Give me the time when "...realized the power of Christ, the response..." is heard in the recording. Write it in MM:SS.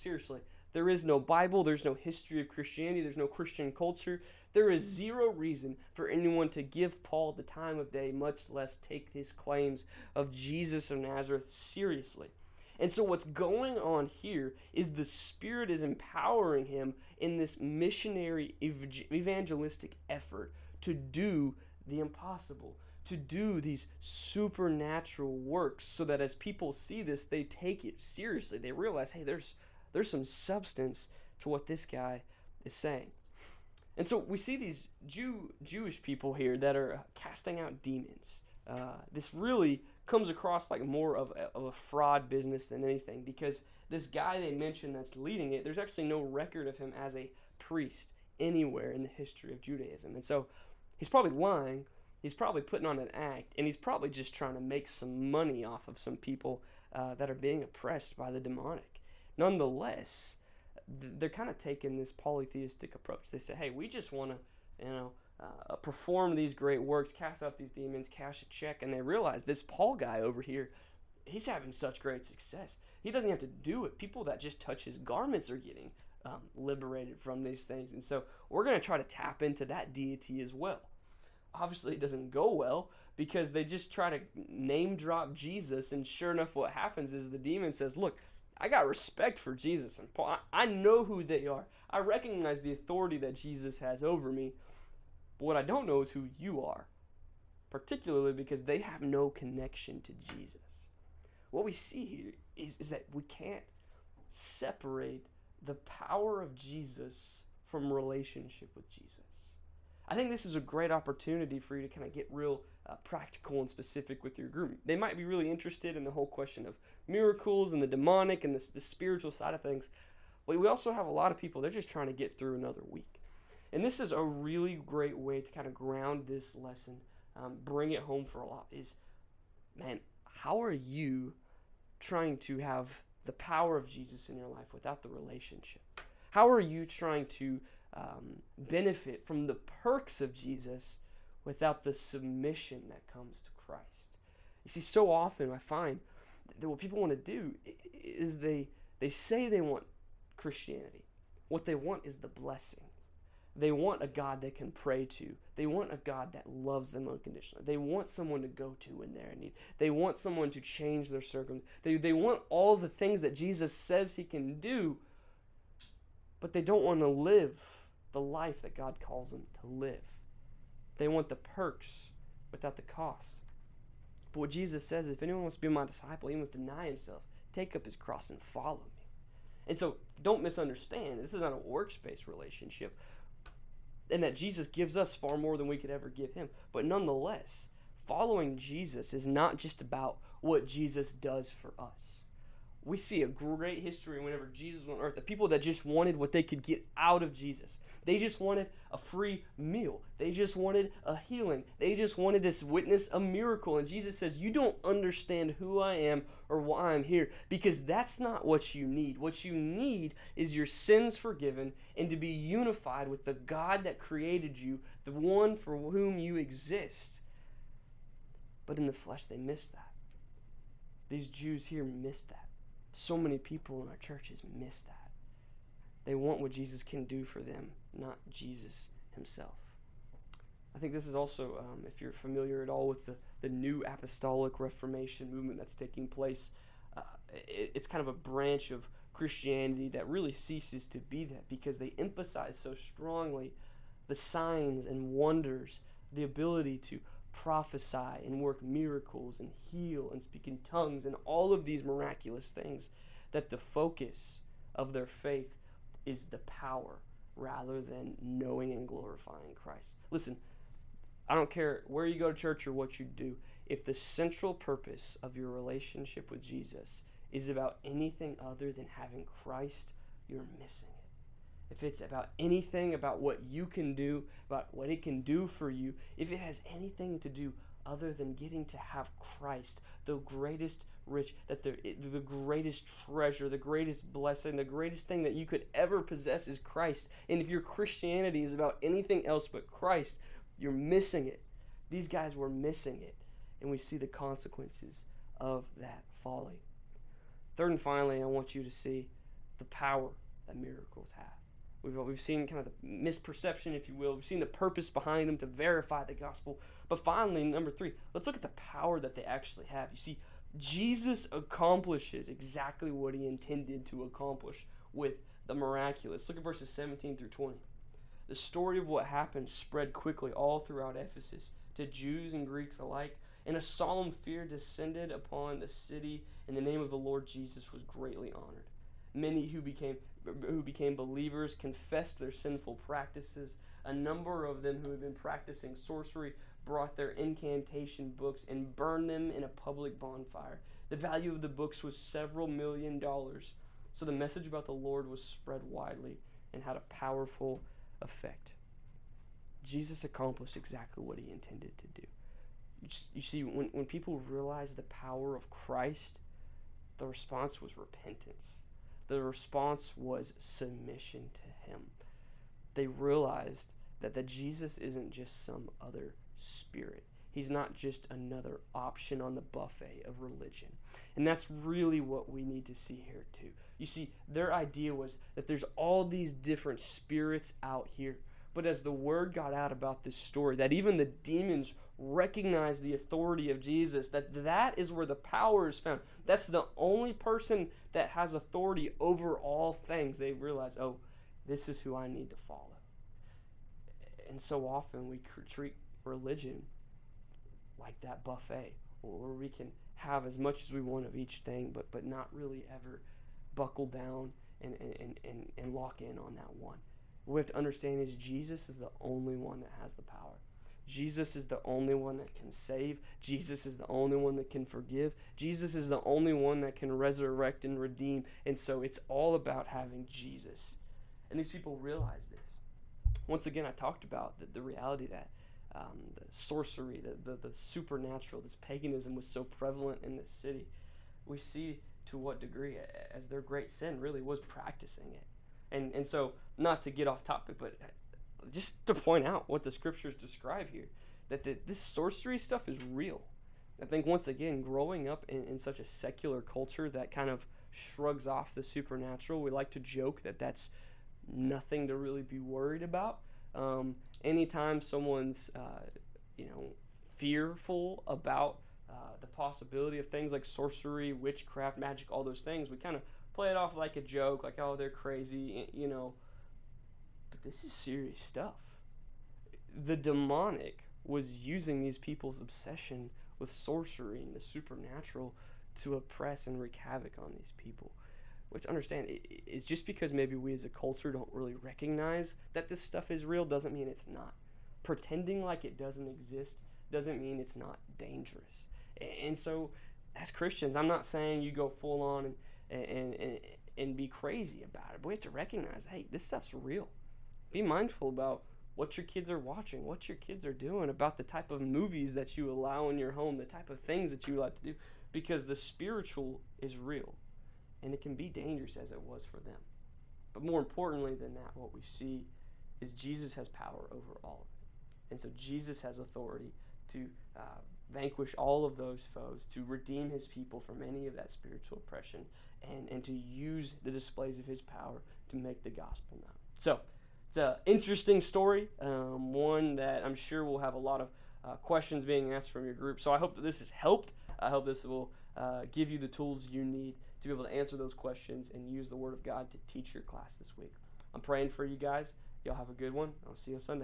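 05:54.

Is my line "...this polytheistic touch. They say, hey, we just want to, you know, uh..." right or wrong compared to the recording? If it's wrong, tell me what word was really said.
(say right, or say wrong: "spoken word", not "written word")
wrong: "approach", not "touch".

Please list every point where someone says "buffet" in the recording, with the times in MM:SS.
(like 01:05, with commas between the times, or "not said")
06:09, 06:38.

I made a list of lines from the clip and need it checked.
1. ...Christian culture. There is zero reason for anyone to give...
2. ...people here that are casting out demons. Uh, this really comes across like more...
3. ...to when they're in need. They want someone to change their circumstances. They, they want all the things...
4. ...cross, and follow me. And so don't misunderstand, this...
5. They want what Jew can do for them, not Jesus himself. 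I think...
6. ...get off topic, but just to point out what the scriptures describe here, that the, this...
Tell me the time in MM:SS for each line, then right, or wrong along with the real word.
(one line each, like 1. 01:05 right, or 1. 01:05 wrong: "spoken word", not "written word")
1. 00:03 right
2. 00:36 right
3. 02:38 right
4. 02:57 right
5. 03:46 wrong: "Jesus", not "Jew"
6. 07:16 right.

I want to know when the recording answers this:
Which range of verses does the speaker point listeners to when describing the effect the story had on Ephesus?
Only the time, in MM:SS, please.
05:16.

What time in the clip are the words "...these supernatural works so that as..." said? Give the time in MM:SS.
00:23.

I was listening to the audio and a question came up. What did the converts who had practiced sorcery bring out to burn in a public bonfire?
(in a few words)
incantation books.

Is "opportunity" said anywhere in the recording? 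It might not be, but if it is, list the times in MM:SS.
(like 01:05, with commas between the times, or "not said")
01:50.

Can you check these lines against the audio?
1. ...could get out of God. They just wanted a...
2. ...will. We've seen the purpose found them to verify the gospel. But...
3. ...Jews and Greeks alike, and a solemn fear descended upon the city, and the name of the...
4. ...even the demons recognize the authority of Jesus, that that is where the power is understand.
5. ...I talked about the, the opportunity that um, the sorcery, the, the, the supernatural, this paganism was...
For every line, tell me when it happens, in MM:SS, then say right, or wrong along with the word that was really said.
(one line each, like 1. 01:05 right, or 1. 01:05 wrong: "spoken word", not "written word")
1. 03:16 wrong: "Jesus", not "God"
2. 05:03 wrong: "behind", not "found"
3. 05:21 right
4. 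06:20 wrong: "found", not "understand"
5. 07:03 wrong: "reality", not "opportunity".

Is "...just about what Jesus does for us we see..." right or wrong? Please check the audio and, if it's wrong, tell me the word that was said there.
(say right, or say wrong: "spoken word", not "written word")
right.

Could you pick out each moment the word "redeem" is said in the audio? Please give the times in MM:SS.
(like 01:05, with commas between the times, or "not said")
06:57, 08:39.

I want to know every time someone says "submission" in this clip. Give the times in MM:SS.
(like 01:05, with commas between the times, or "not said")
02:21, 06:00.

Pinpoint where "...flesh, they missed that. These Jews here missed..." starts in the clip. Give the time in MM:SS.
03:38.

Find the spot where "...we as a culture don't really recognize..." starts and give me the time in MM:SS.
08:00.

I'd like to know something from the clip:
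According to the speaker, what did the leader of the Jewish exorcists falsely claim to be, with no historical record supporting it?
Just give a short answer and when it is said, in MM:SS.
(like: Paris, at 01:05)
a priest, at 00:47.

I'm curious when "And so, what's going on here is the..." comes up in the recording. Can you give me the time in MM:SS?
00:12.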